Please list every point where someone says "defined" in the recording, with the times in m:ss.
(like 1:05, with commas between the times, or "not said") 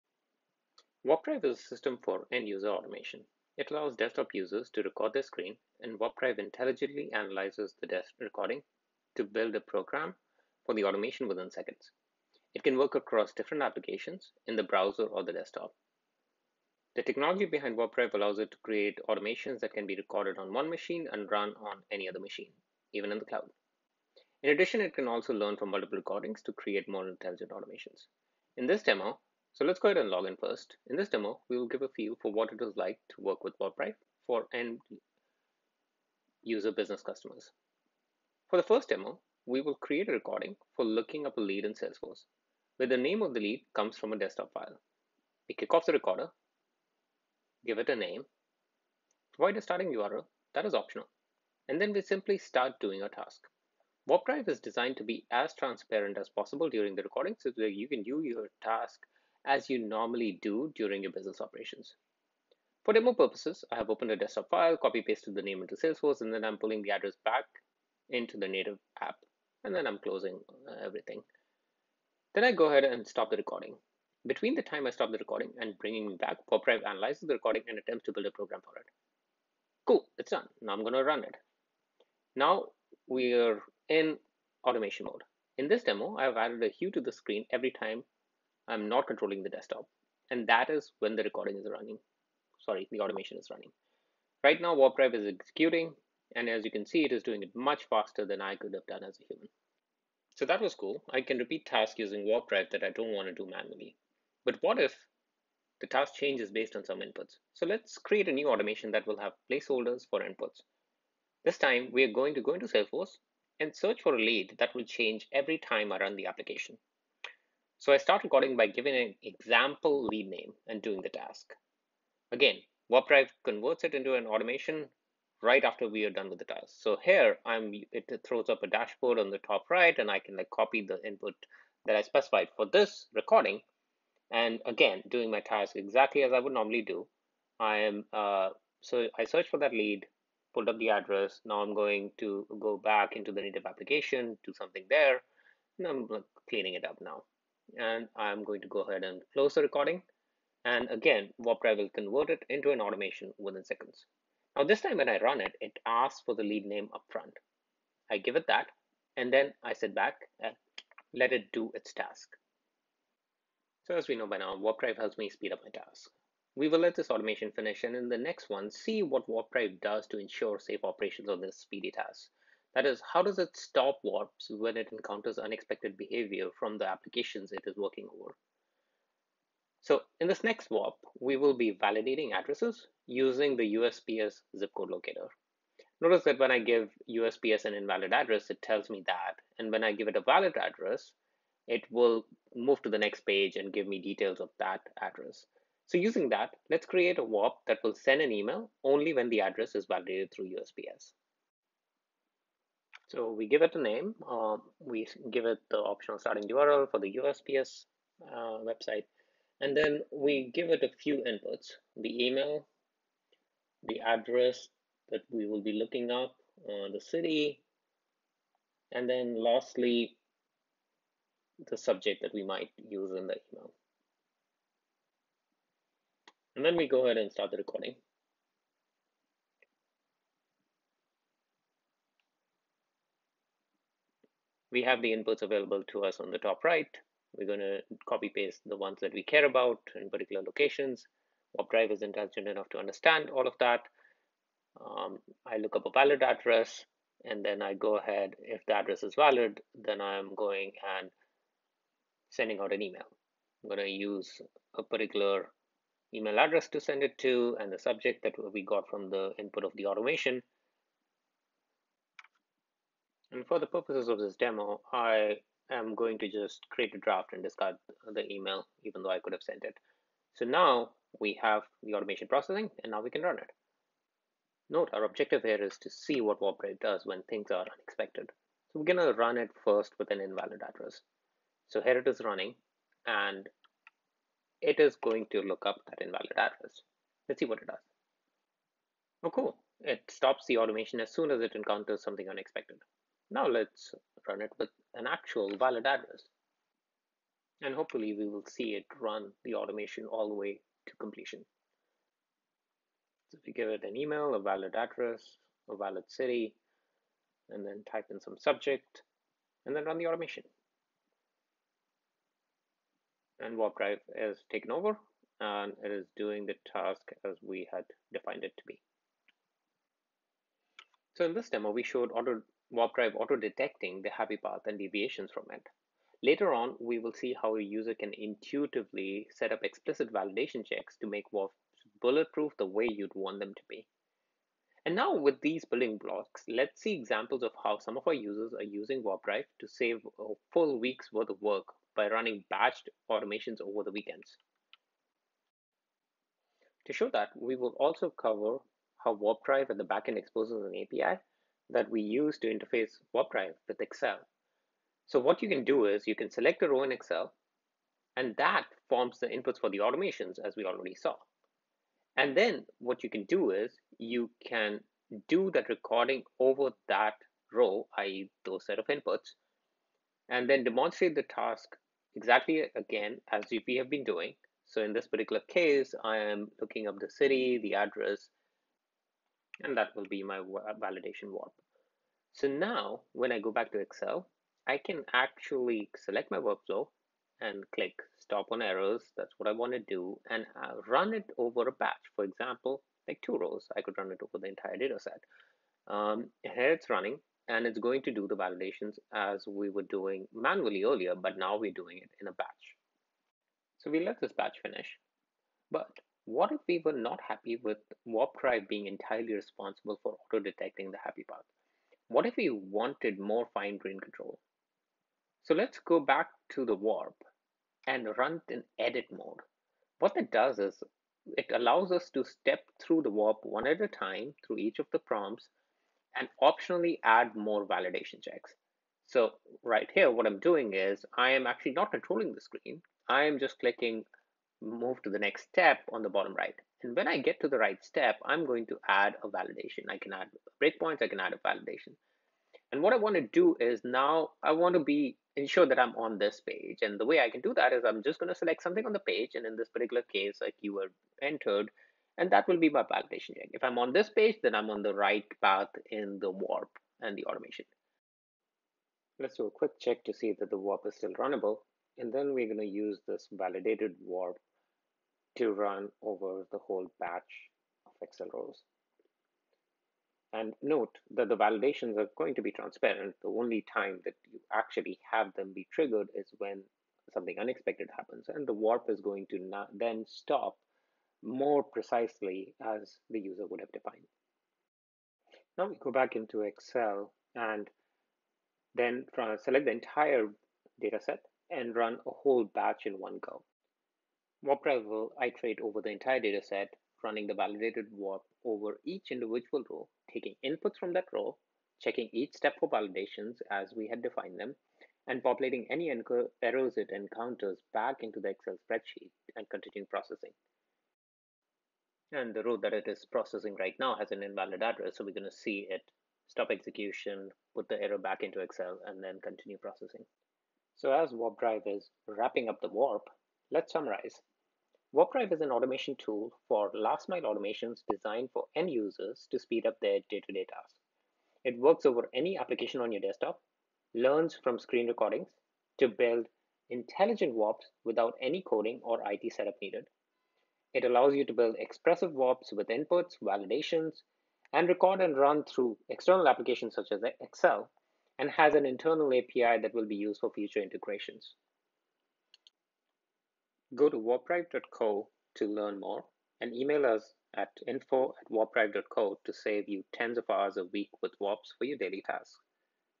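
5:18, 8:03, 8:24.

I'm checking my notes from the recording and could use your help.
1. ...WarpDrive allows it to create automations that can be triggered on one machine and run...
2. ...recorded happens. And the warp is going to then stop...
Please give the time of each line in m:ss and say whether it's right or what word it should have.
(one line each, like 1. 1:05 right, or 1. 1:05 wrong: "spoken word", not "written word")
1. 0:17 wrong: "recorded", not "triggered"
2. 7:57 wrong: "unexpected", not "recorded".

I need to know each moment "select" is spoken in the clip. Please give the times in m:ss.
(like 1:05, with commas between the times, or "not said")
5:56, 6:25, 7:28, 8:09.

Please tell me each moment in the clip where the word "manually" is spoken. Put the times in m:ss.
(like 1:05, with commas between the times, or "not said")
1:43, 6:40.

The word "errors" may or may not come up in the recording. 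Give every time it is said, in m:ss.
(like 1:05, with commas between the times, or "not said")
6:28, 8:25, 8:37.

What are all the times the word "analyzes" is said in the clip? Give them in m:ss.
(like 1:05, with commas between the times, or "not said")
0:07, 1:16.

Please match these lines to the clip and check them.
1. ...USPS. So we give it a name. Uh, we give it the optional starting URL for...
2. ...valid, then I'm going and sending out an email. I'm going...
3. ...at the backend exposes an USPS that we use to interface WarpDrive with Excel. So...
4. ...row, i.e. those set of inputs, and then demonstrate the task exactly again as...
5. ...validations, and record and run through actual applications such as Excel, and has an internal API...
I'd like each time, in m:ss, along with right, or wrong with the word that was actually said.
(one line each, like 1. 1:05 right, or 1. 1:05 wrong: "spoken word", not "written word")
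1. 3:20 right
2. 4:09 right
3. 5:49 wrong: "API", not "USPS"
4. 6:07 right
5. 9:03 wrong: "external", not "actual".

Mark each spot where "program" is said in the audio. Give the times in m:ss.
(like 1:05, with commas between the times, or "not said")
0:09, 1:18.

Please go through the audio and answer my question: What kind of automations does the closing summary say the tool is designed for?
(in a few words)
Last mile automations.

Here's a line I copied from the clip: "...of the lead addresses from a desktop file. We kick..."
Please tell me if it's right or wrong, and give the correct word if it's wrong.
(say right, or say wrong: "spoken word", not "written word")
wrong: "comes", not "addresses".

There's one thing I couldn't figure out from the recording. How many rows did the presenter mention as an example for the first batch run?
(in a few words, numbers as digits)
2.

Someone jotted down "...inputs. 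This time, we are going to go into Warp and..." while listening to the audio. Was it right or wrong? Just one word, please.
wrong.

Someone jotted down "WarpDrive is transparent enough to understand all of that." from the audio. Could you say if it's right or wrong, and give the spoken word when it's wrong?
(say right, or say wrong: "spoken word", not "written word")
wrong: "intelligent", not "transparent".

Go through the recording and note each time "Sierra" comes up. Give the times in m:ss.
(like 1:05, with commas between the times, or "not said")
not said.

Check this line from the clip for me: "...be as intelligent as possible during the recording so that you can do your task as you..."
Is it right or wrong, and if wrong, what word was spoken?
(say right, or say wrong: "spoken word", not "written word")
wrong: "transparent", not "intelligent".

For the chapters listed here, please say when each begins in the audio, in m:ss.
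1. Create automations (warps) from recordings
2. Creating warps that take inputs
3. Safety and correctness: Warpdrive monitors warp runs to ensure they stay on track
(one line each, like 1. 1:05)
1. 0:31
2. 1:40
3. 2:48.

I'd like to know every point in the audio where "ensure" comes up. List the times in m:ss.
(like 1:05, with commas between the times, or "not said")
2:50, 7:25.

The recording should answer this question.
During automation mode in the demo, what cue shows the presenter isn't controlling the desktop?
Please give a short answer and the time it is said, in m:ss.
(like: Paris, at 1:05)
A hue, at 1:26.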